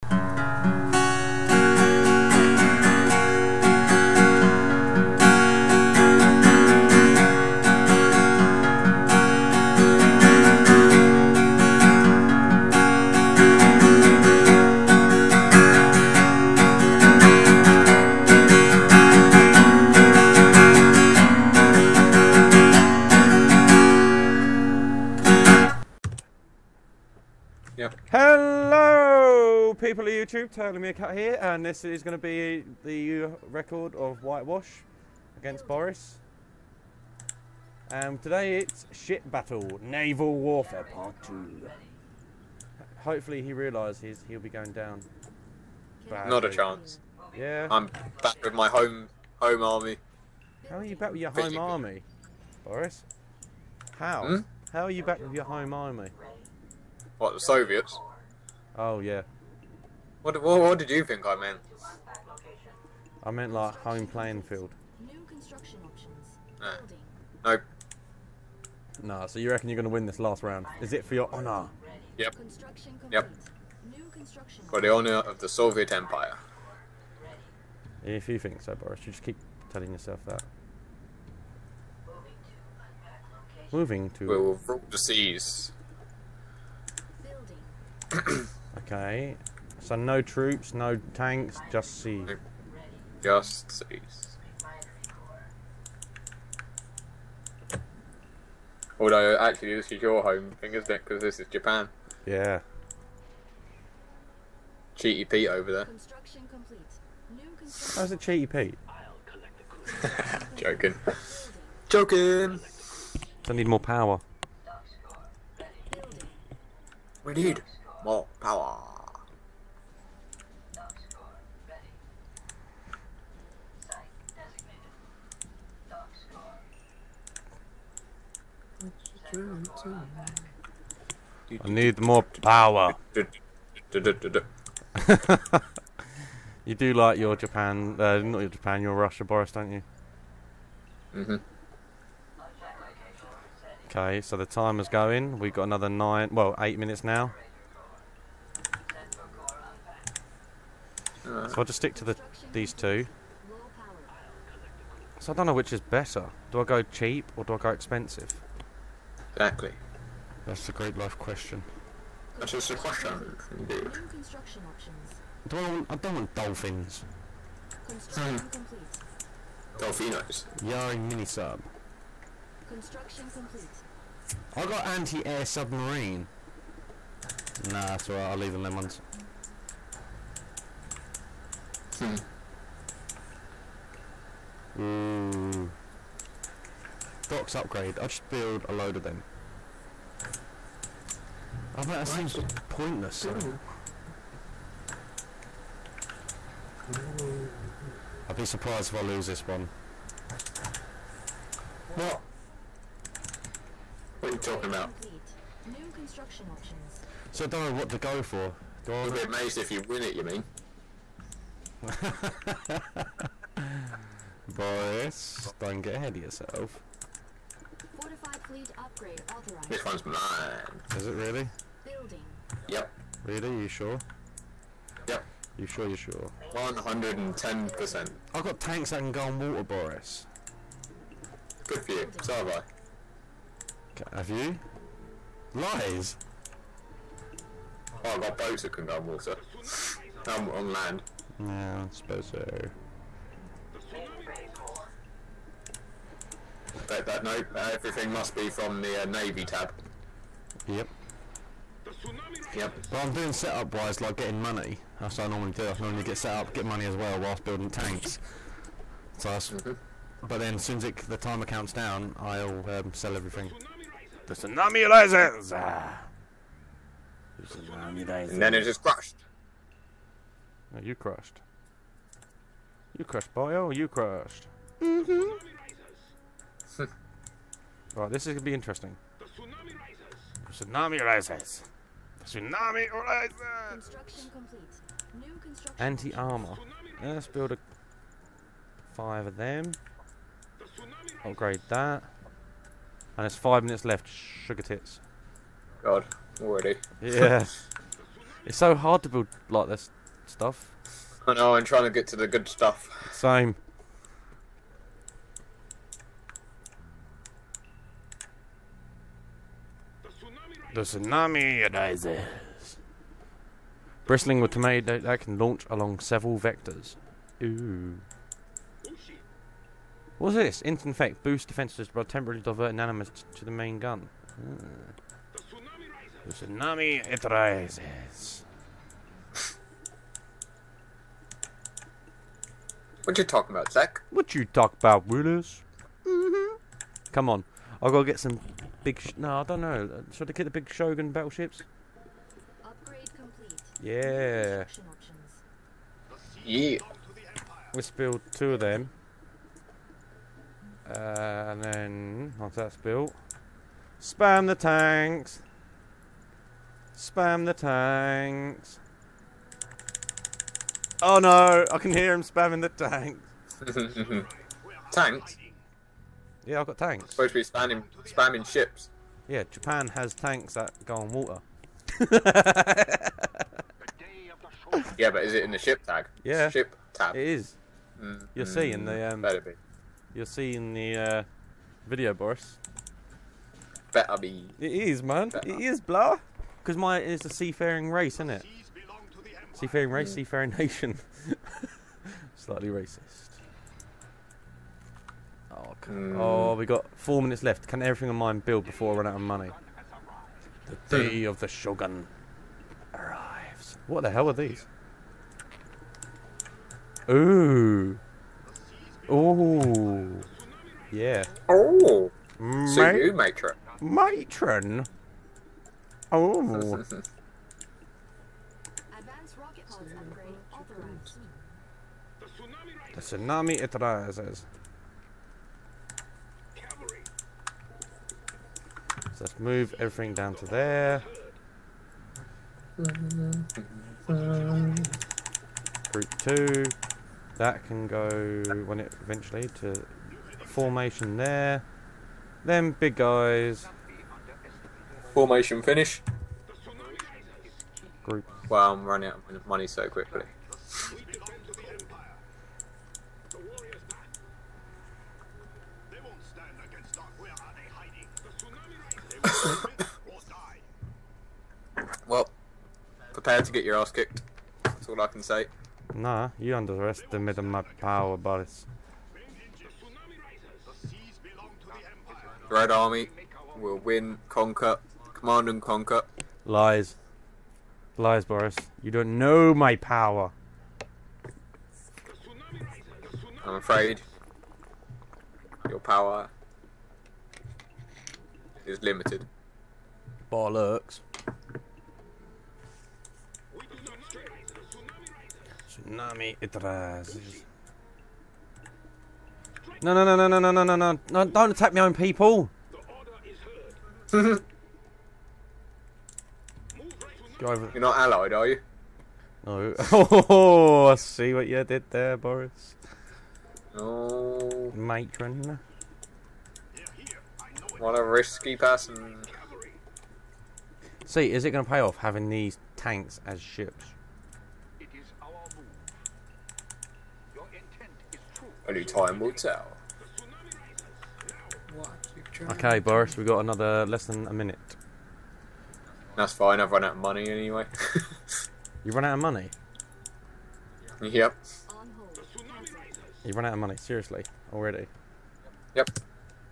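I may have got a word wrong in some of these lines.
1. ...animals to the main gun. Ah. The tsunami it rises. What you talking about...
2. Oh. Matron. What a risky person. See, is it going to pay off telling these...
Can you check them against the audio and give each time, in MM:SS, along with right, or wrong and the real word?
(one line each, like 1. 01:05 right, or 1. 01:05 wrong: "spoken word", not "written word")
1. 05:22 right
2. 08:33 wrong: "having", not "telling".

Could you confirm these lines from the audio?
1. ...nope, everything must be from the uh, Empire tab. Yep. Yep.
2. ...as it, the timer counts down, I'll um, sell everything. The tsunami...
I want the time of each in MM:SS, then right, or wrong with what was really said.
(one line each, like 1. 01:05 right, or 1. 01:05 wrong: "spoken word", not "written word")
1. 04:07 wrong: "Navy", not "Empire"
2. 04:20 right.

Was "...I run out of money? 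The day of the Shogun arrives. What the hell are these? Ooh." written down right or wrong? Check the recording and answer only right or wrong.
right.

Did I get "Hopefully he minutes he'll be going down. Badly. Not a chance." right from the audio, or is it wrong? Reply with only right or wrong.
wrong.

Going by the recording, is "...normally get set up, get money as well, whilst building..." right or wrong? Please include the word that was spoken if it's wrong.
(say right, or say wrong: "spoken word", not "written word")
right.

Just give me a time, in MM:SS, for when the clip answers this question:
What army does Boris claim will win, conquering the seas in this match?
07:52.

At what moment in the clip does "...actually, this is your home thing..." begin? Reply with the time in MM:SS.
01:39.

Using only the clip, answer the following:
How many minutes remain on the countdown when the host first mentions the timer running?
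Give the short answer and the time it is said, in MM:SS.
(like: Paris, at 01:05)
8, at 02:26.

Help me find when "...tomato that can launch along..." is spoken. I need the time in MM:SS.
05:14.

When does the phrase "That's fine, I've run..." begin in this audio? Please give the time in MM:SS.
08:56.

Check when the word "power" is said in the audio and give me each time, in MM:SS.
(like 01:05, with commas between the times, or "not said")
01:53, 01:58, 02:12, 07:47, 07:59, 08:05.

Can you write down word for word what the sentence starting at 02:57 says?
Nah, that's alright, I'll leave them them ones.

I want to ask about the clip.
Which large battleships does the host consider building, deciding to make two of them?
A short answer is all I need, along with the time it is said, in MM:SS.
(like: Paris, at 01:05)
Shogun battleships, at 05:40.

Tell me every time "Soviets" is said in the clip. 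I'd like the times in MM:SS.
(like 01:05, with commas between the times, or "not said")
00:57, 01:15.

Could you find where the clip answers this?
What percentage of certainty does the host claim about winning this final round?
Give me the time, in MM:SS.
03:46.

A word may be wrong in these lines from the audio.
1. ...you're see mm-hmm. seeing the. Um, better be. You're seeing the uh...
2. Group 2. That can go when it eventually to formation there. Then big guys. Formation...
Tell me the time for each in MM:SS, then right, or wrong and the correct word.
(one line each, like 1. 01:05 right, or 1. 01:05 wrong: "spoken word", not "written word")
1. 06:18 right
2. 07:15 right.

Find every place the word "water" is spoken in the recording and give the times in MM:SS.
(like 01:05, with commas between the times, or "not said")
03:49, 03:59, 06:11.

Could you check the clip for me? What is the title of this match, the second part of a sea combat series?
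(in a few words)
Ship Battle.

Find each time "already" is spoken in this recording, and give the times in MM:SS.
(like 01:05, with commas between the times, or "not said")
04:56, 09:04.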